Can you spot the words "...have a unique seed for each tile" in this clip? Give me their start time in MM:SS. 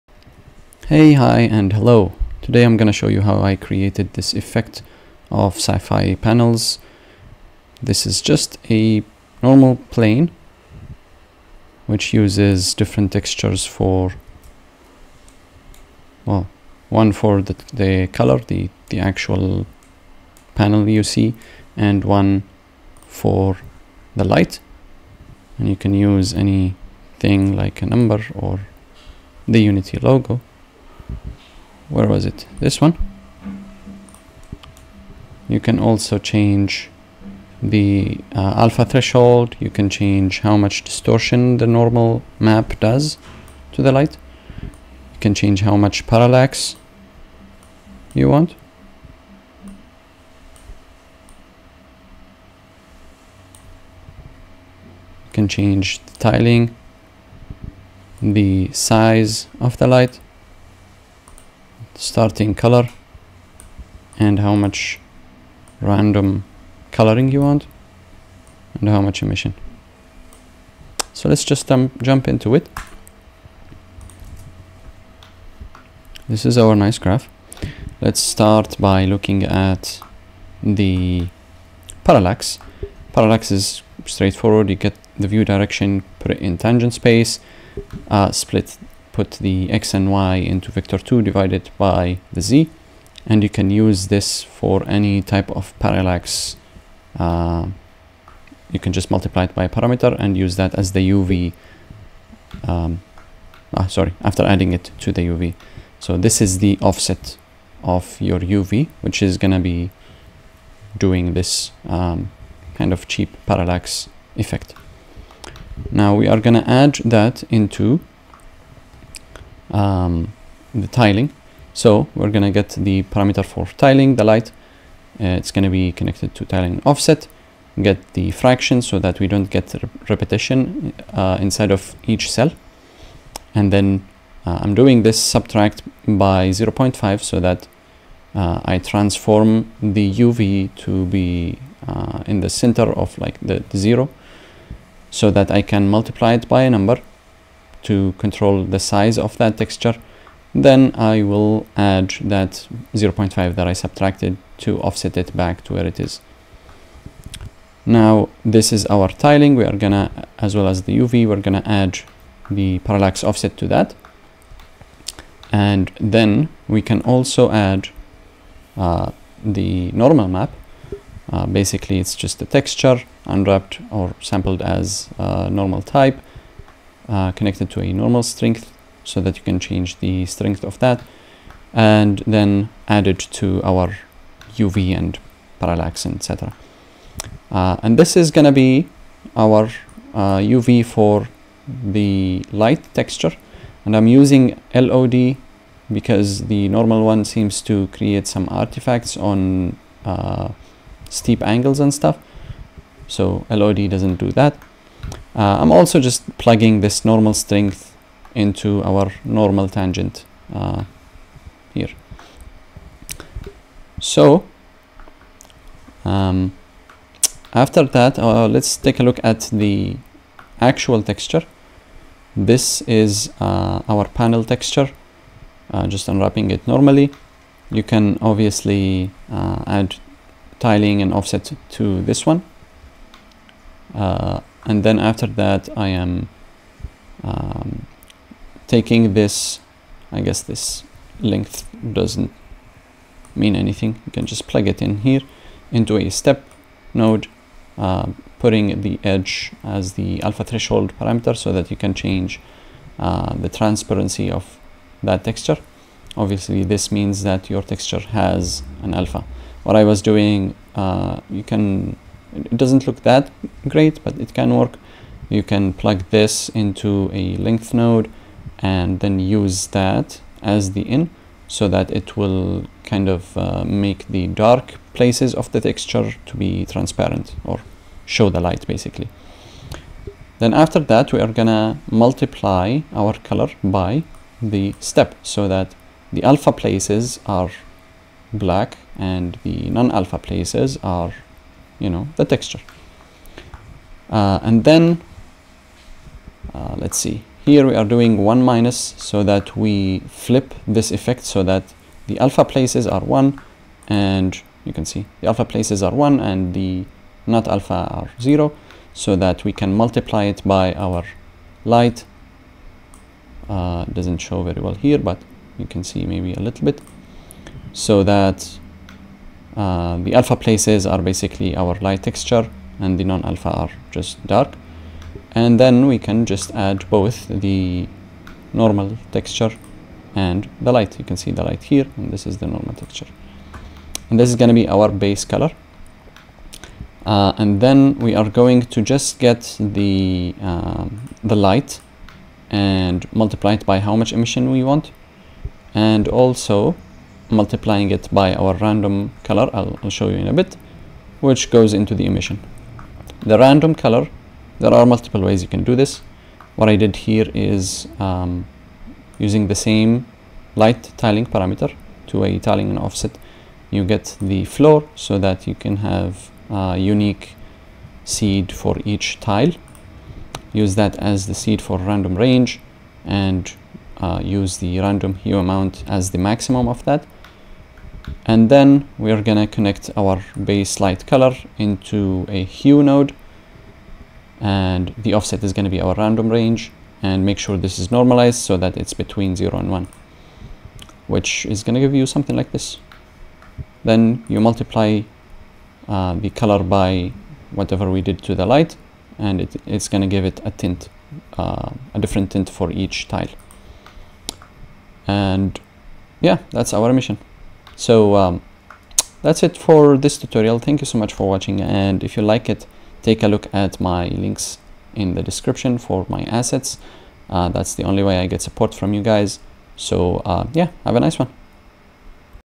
06:05.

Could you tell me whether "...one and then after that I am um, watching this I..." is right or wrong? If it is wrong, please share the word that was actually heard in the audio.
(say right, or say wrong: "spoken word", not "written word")
wrong: "taking", not "watching".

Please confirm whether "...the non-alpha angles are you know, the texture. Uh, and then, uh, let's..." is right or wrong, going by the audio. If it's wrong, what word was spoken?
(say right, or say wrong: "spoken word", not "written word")
wrong: "places", not "angles".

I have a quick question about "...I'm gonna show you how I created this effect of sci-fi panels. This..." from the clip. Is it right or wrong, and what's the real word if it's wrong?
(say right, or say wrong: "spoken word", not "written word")
right.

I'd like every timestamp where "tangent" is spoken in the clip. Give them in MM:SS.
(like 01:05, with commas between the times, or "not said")
01:26, 03:29.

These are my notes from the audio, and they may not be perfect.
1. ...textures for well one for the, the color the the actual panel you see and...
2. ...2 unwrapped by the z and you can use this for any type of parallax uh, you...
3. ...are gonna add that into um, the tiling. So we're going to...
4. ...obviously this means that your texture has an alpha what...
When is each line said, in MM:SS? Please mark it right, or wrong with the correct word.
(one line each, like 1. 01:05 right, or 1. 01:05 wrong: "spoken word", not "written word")
1. 00:13 right
2. 01:30 wrong: "divided", not "unwrapped"
3. 01:56 right
4. 04:16 right.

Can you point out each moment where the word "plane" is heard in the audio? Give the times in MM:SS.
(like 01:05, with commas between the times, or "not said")
00:09.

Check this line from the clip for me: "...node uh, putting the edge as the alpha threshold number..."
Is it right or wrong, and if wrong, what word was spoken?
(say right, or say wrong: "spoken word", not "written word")
wrong: "parameter", not "number".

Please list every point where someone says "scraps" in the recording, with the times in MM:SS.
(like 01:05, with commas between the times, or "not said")
not said.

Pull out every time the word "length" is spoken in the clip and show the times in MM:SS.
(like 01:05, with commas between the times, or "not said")
04:01, 04:27.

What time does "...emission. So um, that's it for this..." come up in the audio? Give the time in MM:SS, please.
06:46.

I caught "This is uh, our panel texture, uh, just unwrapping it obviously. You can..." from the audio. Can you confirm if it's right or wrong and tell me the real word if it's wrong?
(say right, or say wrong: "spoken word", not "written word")
wrong: "normally", not "obviously".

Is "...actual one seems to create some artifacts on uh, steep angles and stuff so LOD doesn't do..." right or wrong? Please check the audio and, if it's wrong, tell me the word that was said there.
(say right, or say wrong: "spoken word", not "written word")
wrong: "normal", not "actual".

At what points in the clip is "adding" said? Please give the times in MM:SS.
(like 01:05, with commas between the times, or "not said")
01:44.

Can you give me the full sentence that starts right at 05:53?
The random color, there are multiple ways you can do this.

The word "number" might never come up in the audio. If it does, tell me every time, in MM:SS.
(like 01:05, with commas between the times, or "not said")
00:27, 02:26.